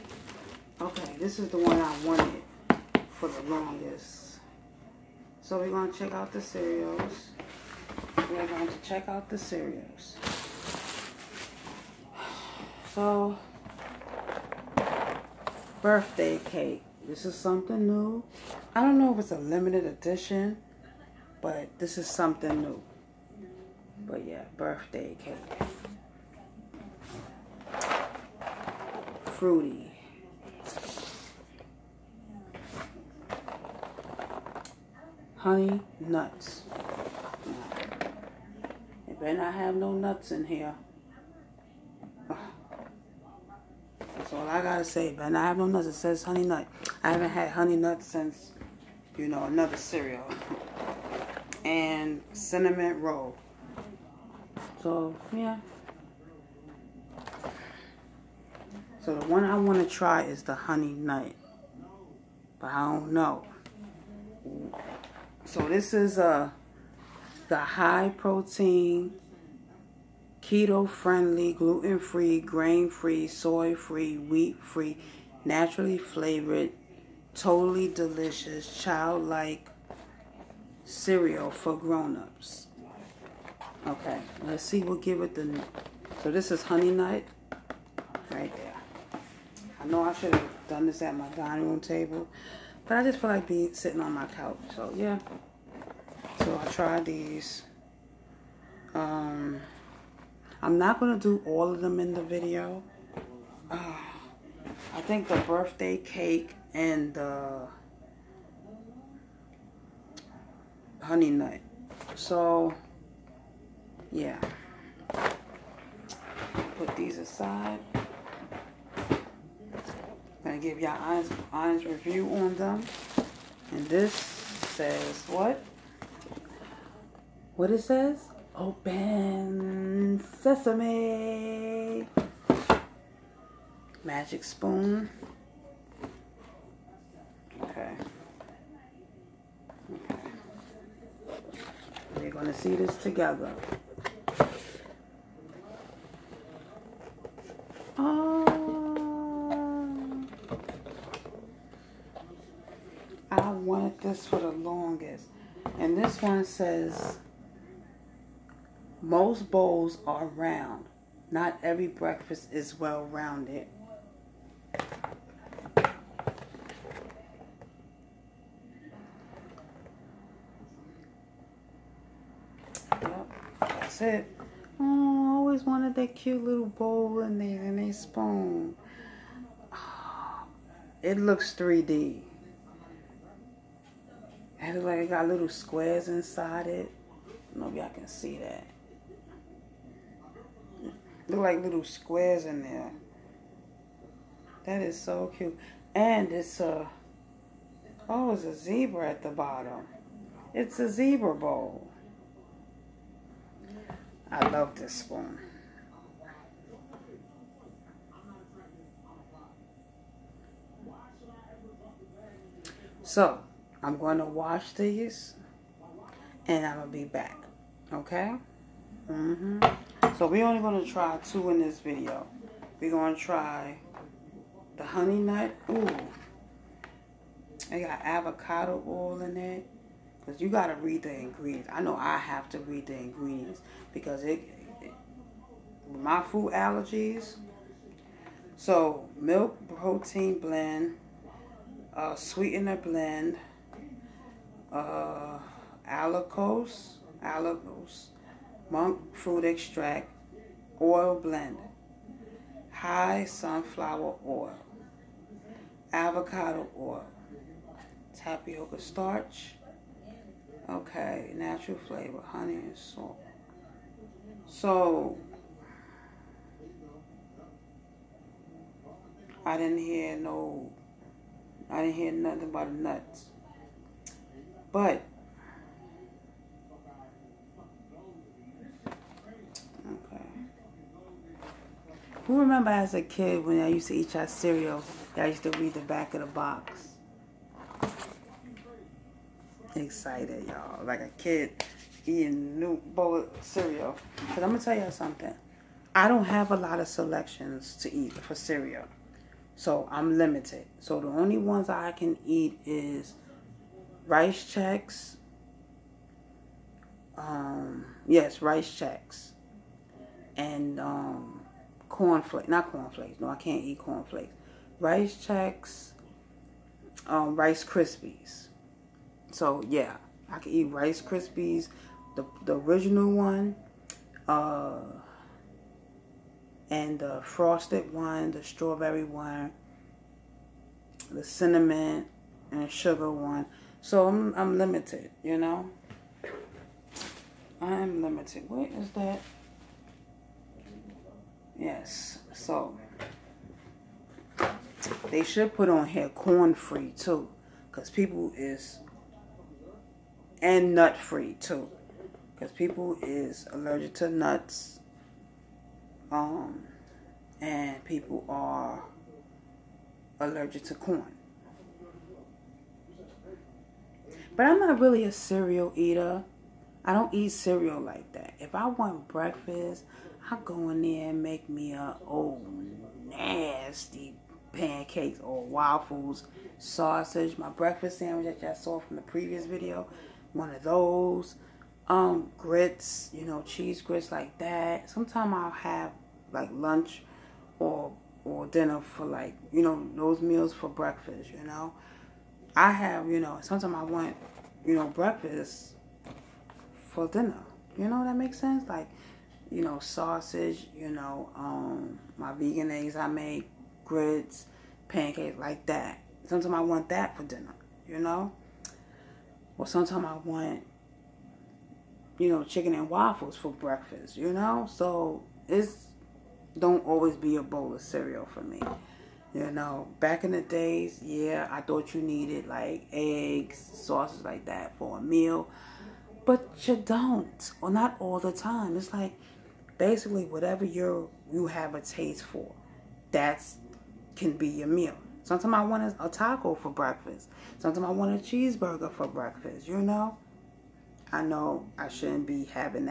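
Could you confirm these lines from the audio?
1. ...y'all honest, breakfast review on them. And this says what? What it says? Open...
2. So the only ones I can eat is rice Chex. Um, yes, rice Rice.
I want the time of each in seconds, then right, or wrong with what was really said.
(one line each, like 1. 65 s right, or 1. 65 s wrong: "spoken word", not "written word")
1. 120 s wrong: "honest", not "breakfast"
2. 300 s wrong: "Chex", not "Rice".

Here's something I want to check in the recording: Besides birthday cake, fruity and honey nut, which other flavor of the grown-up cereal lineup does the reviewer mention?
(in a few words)
Cinnamon roll.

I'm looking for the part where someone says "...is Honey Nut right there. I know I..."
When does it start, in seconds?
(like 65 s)
86 s.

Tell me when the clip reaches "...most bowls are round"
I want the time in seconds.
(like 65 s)
159 s.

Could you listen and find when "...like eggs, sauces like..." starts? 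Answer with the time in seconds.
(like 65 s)
422 s.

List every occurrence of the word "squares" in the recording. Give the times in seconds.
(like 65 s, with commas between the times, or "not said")
185 s, 191 s.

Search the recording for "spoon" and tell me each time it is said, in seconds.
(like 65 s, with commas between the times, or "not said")
134 s, 177 s, 204 s.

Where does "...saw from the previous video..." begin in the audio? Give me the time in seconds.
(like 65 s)
378 s.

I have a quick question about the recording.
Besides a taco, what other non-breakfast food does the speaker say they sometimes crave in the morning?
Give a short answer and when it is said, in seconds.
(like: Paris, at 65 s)
Cheeseburger, at 438 s.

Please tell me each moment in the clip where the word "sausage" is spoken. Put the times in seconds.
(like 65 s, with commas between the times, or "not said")
376 s, 399 s.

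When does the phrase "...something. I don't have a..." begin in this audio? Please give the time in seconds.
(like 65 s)
294 s.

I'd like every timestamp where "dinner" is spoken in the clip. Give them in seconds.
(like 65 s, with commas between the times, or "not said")
388 s, 397 s, 407 s.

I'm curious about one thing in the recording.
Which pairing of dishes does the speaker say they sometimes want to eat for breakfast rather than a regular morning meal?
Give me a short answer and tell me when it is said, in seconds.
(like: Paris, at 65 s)
Chicken and waffles, at 412 s.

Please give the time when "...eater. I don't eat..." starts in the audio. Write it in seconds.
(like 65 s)
365 s.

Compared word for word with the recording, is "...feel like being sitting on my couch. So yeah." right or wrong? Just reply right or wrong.
right.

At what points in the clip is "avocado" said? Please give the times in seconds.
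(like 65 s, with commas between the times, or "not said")
228 s, 255 s.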